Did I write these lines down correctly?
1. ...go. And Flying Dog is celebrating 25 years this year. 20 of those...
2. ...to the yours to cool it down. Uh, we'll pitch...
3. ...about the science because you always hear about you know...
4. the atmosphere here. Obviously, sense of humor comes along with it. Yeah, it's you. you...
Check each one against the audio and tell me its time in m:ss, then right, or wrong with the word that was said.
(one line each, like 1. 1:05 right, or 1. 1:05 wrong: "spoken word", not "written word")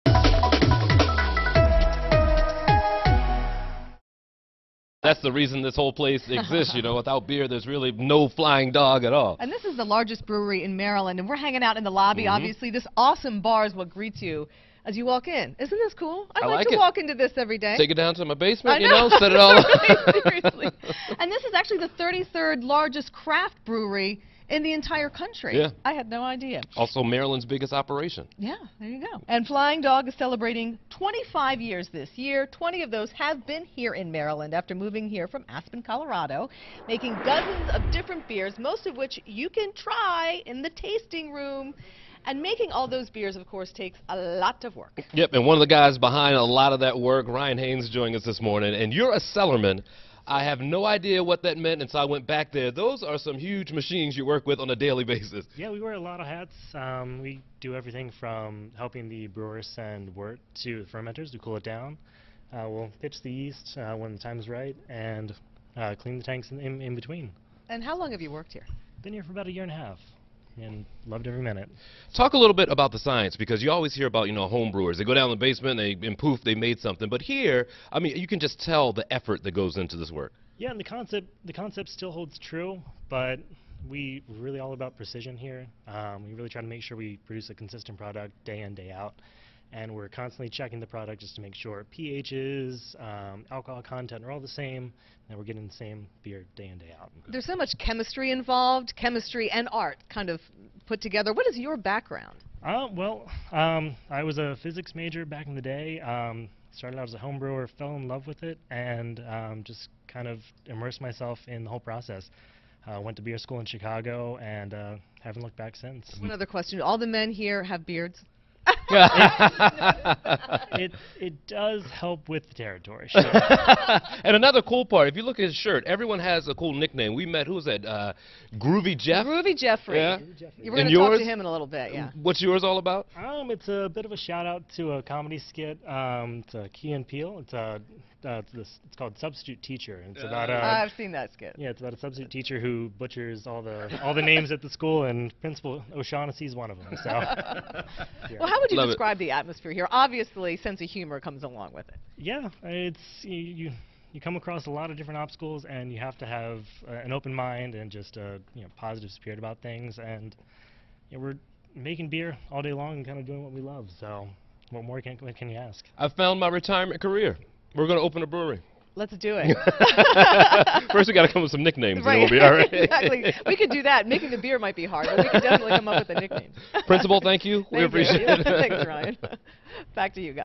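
1. 0:28 right
2. 1:00 wrong: "fermenters", not "yours"
3. 1:12 right
4. 2:29 right.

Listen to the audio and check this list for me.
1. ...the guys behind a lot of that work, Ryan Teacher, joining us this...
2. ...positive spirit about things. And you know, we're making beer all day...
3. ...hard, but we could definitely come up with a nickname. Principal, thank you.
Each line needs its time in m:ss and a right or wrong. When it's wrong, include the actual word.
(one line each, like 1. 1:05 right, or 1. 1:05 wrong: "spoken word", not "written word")
1. 0:45 wrong: "Haynes", not "Teacher"
2. 2:38 right
3. 2:54 right.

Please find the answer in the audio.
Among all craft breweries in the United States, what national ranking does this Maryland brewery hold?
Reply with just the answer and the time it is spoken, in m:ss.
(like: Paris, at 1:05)
33rd, at 0:22.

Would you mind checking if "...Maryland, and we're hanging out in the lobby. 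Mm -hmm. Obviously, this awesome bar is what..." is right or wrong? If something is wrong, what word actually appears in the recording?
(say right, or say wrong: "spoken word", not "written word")
right.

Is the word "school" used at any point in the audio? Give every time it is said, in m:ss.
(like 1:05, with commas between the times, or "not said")
1:53, 2:24.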